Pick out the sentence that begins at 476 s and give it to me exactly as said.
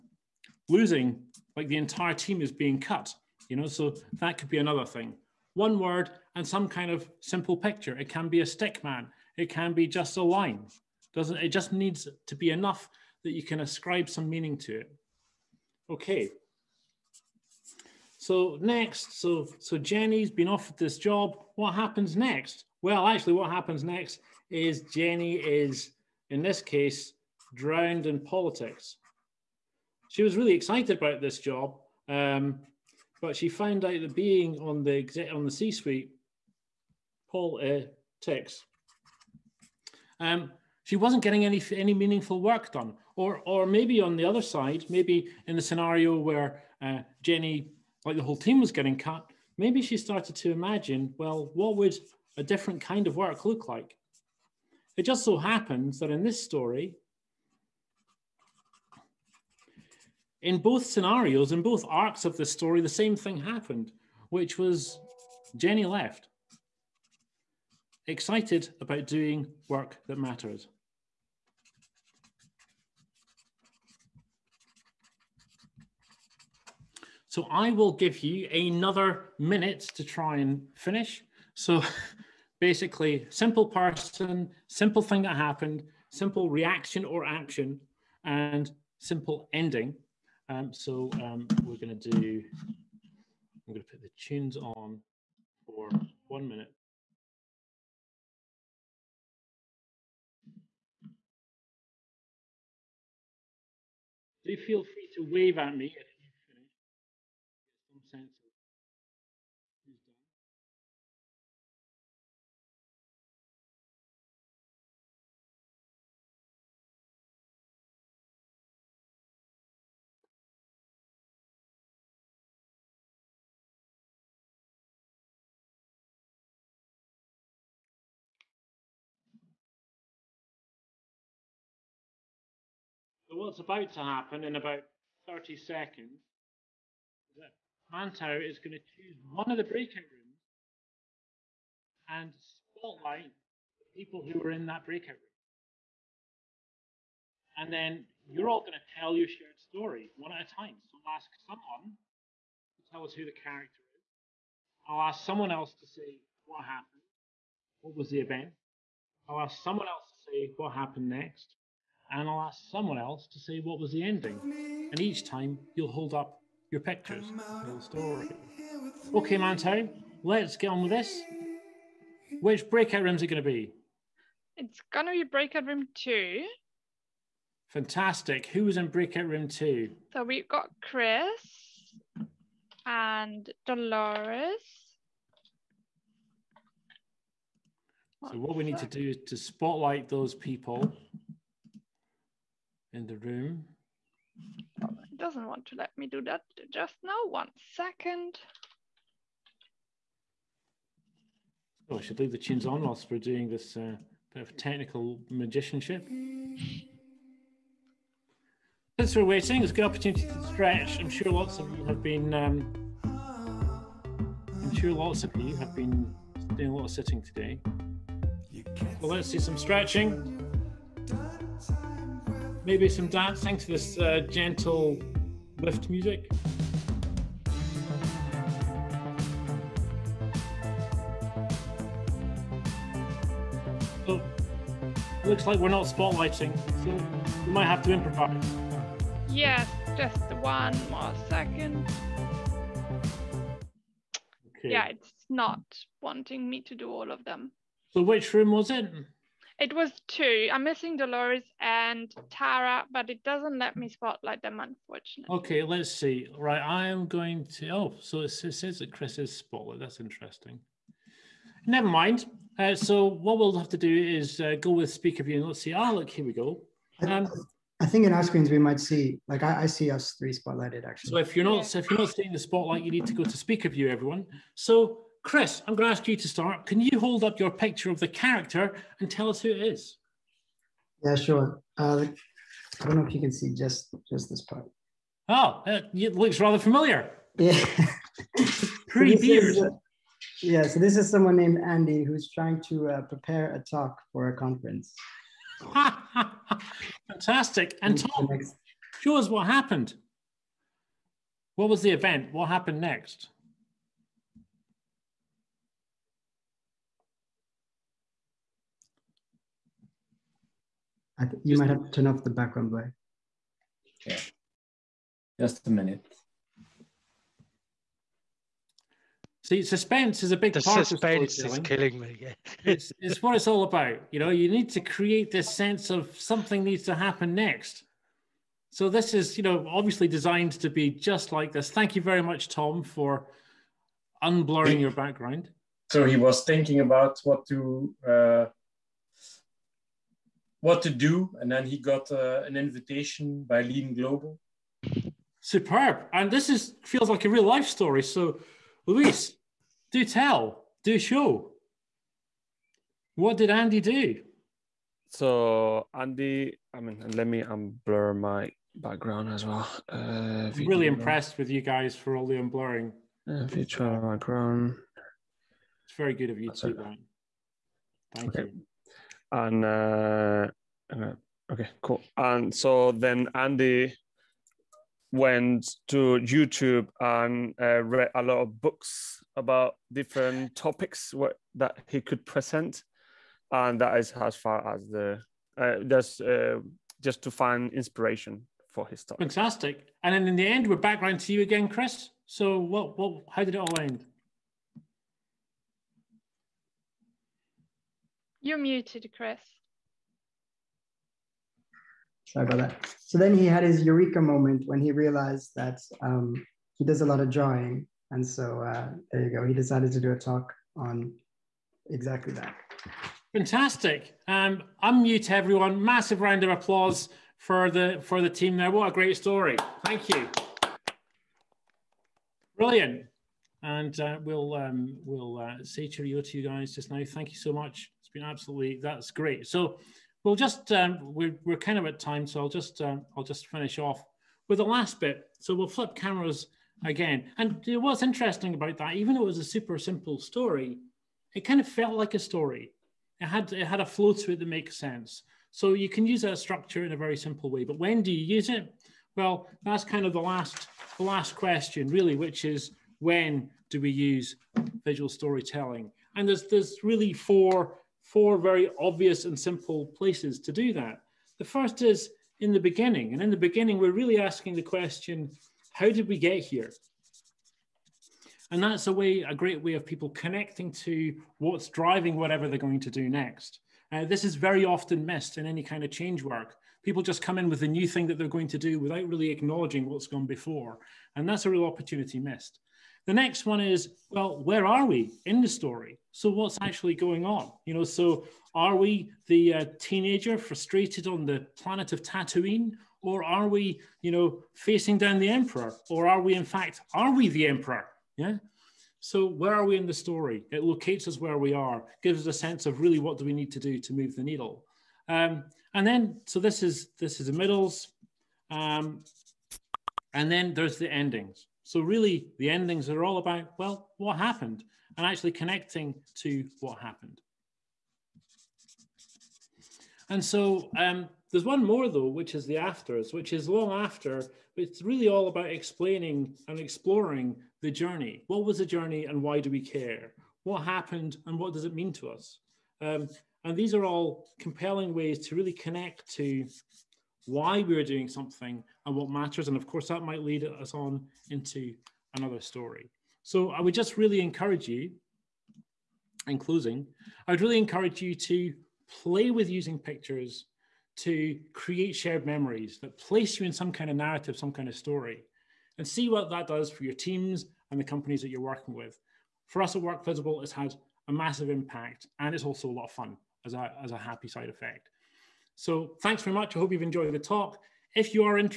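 People just come in with a new thing that they're going to do without really acknowledging what's gone before.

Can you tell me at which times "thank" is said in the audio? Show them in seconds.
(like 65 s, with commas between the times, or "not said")
331 s, 368 s, 419 s, 427 s, 566 s.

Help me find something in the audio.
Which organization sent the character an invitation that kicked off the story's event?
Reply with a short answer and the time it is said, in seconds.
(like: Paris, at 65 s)
Lean Global, at 343 s.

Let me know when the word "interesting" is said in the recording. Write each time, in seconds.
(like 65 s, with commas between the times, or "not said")
259 s, 438 s.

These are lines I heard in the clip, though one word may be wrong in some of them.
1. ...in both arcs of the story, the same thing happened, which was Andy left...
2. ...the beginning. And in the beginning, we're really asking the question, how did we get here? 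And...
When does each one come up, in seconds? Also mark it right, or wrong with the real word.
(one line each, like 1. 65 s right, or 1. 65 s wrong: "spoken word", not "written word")
1. 61 s wrong: "Jenny", not "Andy"
2. 462 s right.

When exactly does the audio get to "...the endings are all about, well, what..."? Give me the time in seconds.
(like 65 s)
512 s.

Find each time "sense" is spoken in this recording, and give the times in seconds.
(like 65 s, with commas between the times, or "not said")
325 s, 444 s, 502 s.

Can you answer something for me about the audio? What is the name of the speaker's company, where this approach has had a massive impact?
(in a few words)
WorkVisible.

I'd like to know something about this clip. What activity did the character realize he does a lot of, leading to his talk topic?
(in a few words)
Drawing.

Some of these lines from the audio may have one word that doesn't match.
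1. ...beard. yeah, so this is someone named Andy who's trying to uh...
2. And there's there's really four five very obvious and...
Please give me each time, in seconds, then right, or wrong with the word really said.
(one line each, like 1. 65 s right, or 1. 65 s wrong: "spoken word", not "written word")
1. 289 s right
2. 456 s wrong: "four", not "five".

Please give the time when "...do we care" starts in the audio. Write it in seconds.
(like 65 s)
529 s.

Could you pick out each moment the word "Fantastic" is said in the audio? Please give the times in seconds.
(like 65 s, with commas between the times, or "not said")
177 s, 297 s, 389 s, 413 s.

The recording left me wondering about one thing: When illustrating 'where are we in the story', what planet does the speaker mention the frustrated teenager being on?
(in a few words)
Tatooine.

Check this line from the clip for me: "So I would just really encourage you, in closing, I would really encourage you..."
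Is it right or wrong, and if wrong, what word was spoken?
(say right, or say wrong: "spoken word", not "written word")
right.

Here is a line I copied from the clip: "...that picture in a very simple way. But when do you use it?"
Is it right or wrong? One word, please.
wrong.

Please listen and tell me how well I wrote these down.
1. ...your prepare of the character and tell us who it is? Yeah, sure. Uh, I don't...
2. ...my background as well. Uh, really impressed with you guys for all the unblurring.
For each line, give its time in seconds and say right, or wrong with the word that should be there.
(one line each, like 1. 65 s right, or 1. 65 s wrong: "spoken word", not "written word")
1. 277 s wrong: "picture", not "prepare"
2. 358 s right.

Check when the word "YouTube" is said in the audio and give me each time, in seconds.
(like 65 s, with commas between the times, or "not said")
376 s.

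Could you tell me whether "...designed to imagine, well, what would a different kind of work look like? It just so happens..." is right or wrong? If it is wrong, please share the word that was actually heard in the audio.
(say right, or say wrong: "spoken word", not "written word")
wrong: "started", not "designed".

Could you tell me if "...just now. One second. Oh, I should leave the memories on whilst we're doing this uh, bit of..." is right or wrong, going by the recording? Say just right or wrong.
wrong.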